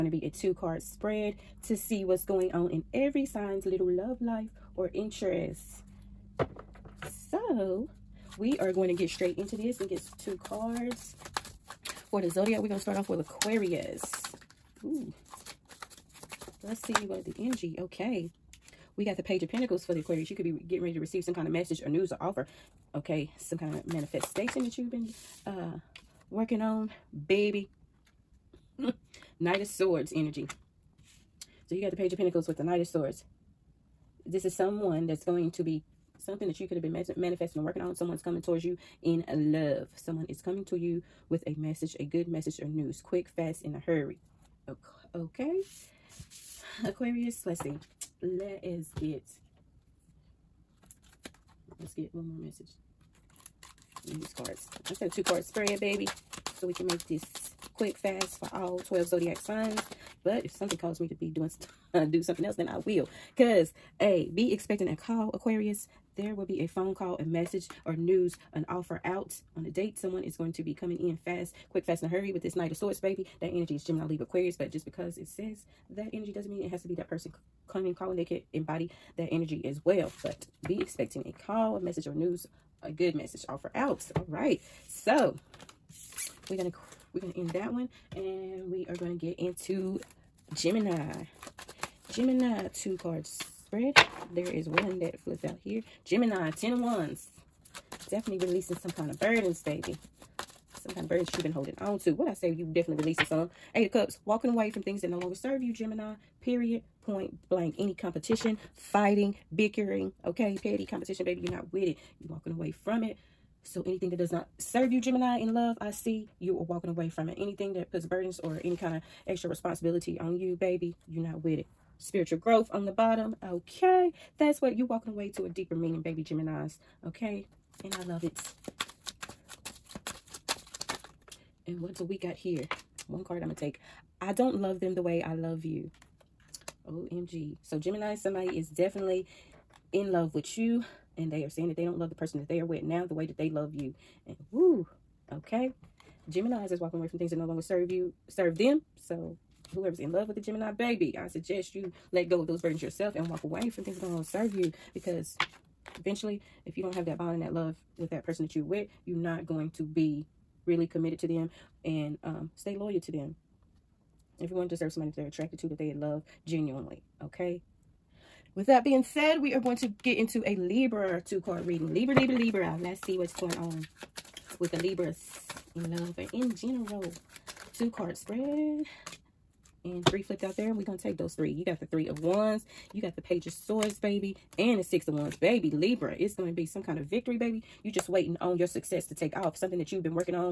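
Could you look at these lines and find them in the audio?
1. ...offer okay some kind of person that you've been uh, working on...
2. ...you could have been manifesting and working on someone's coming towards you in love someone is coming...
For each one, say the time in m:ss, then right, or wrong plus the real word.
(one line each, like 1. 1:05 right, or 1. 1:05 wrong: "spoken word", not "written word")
1. 0:22 wrong: "manifestation", not "person"
2. 0:36 right.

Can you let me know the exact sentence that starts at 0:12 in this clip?
For the Zodiac, we're going to start off with Aquarius.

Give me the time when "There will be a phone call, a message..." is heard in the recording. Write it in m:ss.
1:06.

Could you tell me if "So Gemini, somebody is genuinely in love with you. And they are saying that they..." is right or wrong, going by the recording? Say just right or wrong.
wrong.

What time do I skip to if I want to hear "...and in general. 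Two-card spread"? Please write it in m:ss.
2:56.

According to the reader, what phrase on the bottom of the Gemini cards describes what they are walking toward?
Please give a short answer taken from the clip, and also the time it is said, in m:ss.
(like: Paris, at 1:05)
Spiritual growth, at 2:01.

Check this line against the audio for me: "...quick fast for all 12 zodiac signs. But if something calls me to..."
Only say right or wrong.
right.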